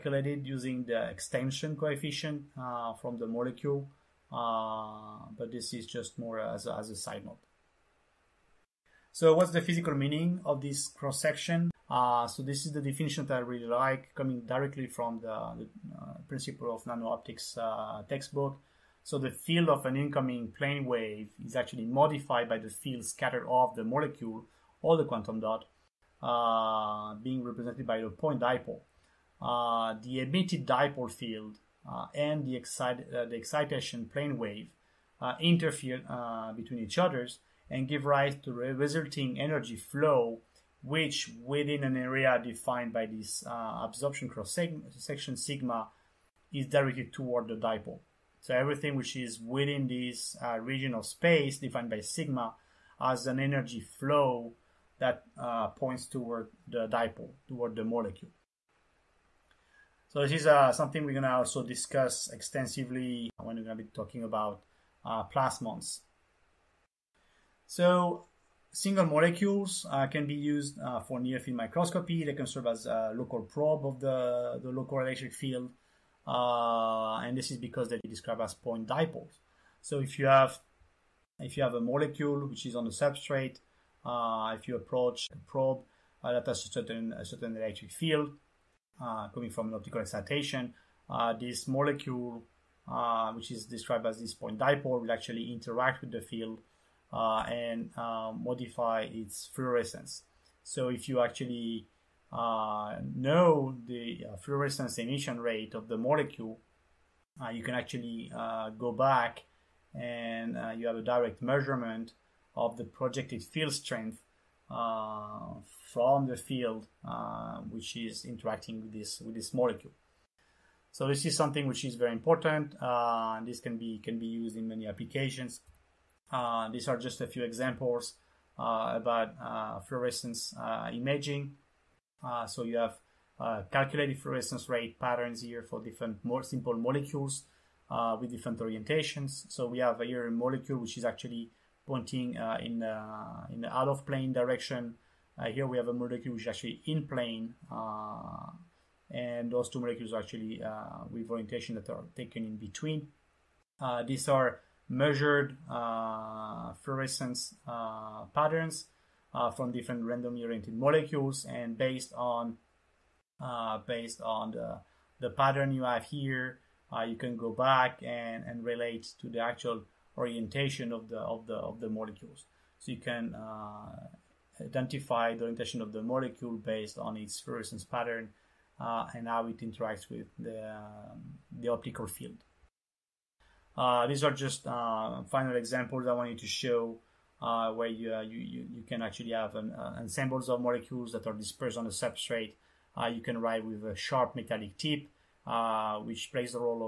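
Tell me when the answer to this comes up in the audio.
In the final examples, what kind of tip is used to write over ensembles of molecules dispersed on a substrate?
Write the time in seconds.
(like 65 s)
193 s.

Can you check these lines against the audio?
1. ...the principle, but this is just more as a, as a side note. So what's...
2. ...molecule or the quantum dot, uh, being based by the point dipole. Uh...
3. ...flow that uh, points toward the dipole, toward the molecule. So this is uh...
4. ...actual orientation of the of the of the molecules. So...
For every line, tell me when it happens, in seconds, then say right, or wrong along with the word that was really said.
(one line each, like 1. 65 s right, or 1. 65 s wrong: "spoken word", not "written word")
1. 3 s wrong: "molecule", not "principle"
2. 23 s wrong: "represented", not "based"
3. 53 s right
4. 169 s right.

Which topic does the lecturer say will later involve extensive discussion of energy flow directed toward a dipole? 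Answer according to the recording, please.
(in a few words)
plasmons.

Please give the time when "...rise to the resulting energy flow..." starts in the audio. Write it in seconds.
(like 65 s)
38 s.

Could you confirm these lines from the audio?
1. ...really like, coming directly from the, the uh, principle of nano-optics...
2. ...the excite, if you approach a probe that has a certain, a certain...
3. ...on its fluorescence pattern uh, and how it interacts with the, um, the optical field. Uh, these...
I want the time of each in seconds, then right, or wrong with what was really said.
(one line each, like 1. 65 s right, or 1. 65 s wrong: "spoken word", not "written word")
1. 13 s right
2. 82 s wrong: "substrate", not "excite"
3. 176 s right.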